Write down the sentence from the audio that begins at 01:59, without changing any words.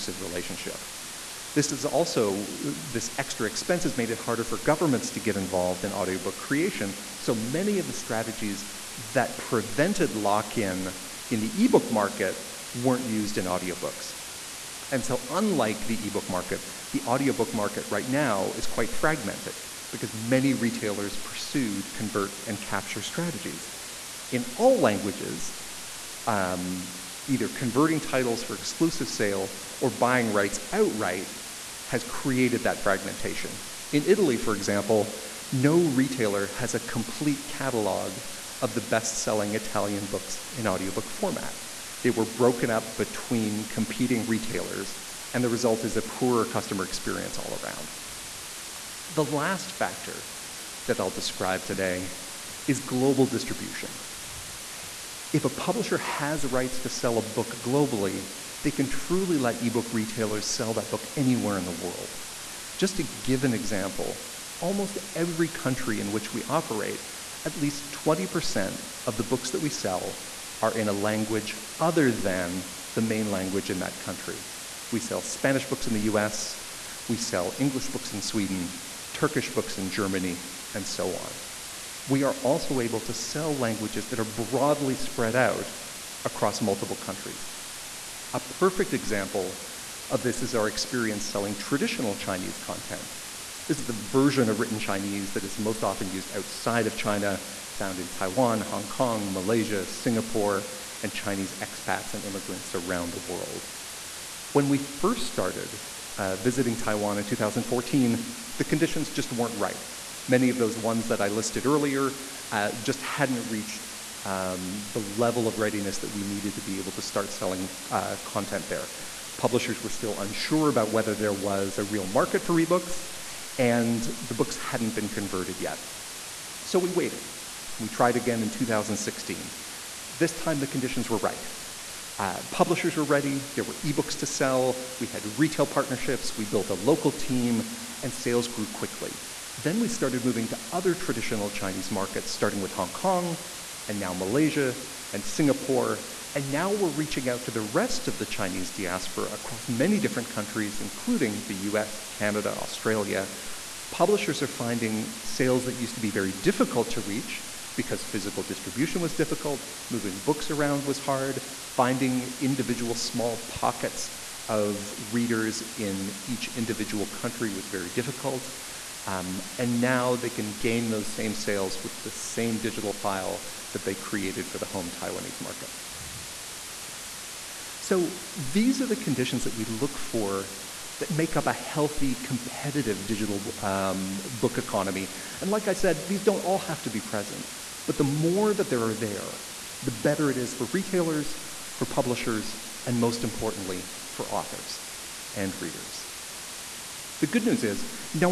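Publishers were still unsure about whether there was a real market for ebooks, and the books hadn't been converted yet.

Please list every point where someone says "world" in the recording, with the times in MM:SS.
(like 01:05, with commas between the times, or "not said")
01:01, 01:43.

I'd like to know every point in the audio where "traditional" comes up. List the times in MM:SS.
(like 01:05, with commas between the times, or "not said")
01:31, 02:20.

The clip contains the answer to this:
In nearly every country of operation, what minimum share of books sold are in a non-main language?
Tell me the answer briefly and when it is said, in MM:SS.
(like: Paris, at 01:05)
20%, at 01:07.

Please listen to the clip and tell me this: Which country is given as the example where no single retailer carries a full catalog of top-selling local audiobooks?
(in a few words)
Italy.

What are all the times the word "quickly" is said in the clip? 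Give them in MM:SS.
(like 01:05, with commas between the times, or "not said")
02:18.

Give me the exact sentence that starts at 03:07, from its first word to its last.
But the more that there are there, the better it is for retailers, for publishers, and most importantly, for authors and readers.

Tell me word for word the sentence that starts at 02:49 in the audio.
Um, and now they can gain those same sales with the same digital file that they created for the home Taiwanese market.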